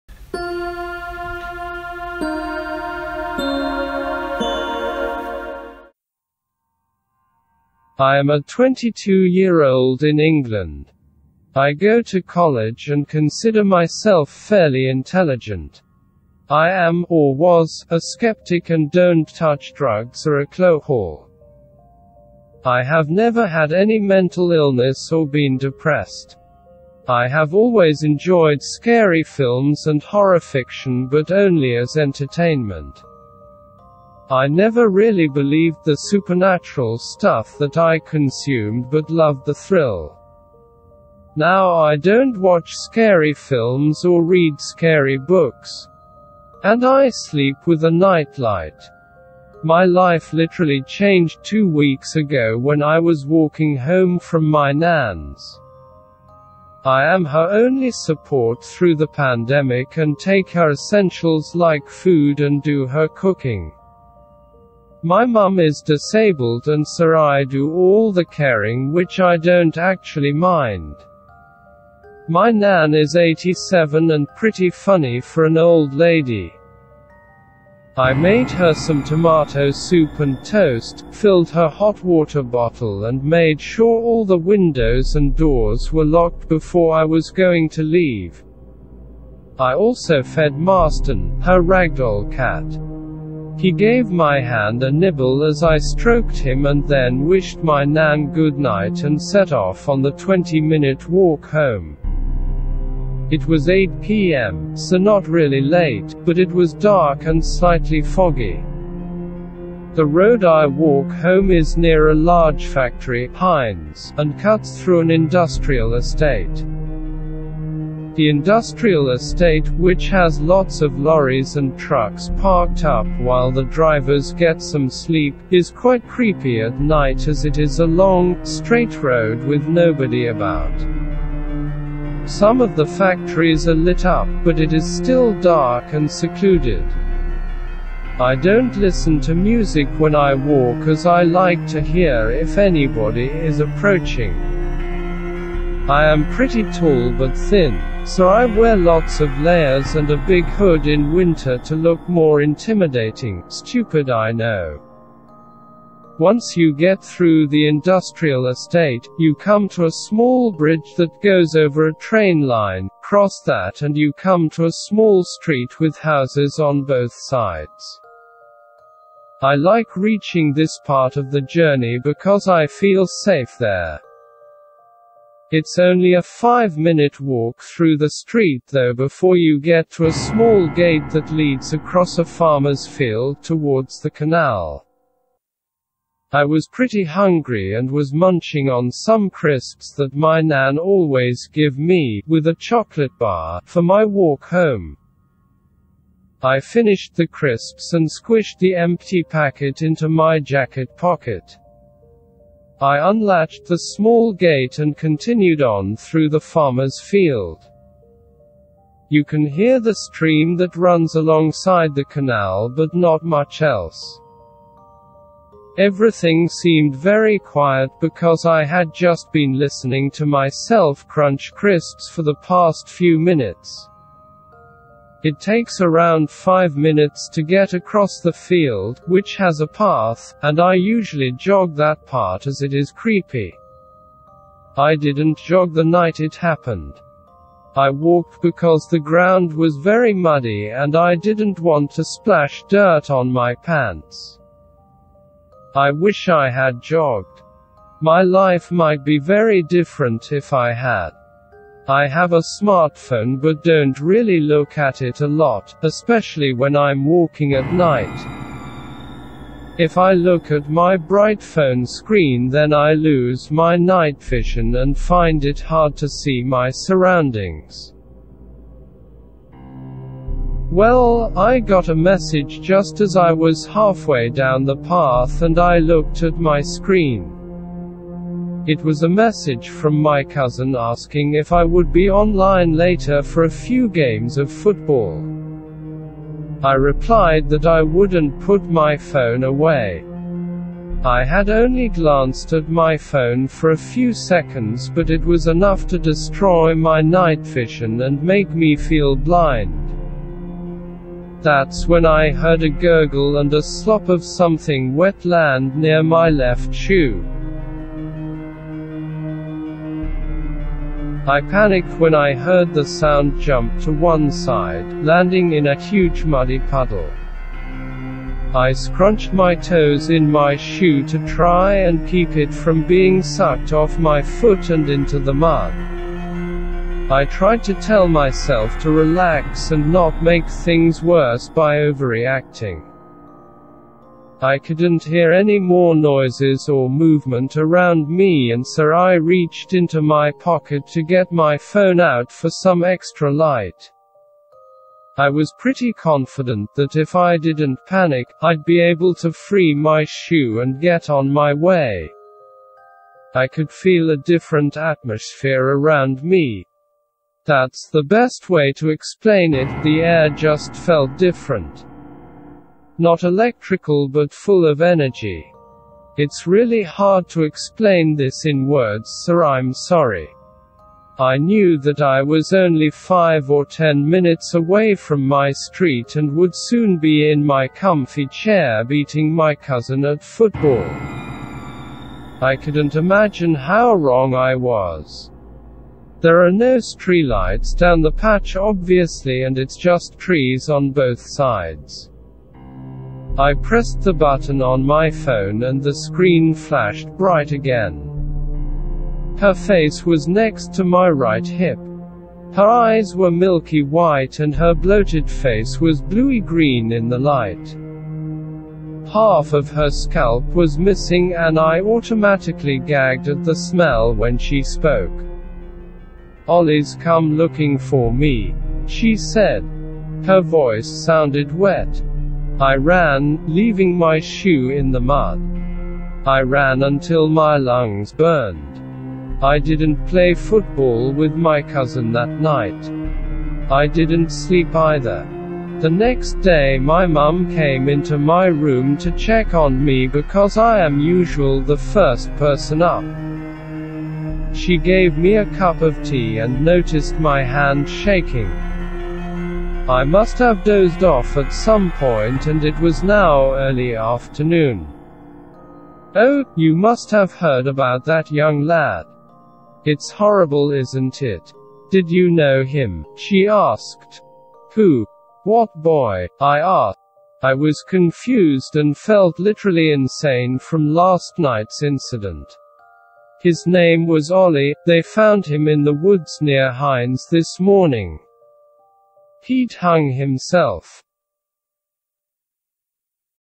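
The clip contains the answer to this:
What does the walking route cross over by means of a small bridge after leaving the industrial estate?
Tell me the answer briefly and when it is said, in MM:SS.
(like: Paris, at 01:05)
train line, at 02:41.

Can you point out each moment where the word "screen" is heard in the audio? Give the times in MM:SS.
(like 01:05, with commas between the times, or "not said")
04:21, 04:36, 06:35.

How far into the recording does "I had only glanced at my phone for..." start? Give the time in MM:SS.
04:51.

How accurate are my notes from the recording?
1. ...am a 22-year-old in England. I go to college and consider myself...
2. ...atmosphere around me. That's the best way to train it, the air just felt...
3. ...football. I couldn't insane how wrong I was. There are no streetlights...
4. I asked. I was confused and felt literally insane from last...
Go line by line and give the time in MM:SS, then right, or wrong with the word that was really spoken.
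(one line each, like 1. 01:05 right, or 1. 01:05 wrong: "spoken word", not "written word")
1. 00:08 right
2. 05:54 wrong: "explain", not "train"
3. 06:20 wrong: "imagine", not "insane"
4. 07:46 right.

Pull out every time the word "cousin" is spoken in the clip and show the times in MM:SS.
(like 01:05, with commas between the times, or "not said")
04:40, 06:19, 07:11.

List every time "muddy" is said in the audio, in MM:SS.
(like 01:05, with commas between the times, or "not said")
04:00, 05:16.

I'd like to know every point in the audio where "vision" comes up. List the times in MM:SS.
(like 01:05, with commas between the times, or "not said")
04:24, 04:57.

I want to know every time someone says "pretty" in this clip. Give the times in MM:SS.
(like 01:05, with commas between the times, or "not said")
01:14, 02:26, 03:06, 05:45.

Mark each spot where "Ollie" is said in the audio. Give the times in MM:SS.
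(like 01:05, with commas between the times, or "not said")
06:56, 07:54.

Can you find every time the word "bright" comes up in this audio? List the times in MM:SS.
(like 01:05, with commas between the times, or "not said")
04:20, 06:37.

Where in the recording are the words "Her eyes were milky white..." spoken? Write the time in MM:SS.
06:42.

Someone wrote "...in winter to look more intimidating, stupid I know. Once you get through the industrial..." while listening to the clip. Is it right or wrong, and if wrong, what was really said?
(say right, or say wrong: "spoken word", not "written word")
right.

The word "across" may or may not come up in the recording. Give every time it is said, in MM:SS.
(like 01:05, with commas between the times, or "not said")
03:01, 03:47.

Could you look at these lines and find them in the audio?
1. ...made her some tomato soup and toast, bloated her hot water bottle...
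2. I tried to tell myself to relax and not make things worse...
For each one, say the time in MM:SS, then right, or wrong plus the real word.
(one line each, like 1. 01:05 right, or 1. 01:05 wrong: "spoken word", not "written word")
1. 01:18 wrong: "filled", not "bloated"
2. 05:27 right.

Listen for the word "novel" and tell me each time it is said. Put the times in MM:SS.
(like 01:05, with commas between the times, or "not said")
not said.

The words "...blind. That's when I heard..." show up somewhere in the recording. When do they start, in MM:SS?
04:59.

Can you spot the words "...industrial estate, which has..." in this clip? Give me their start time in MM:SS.
01:58.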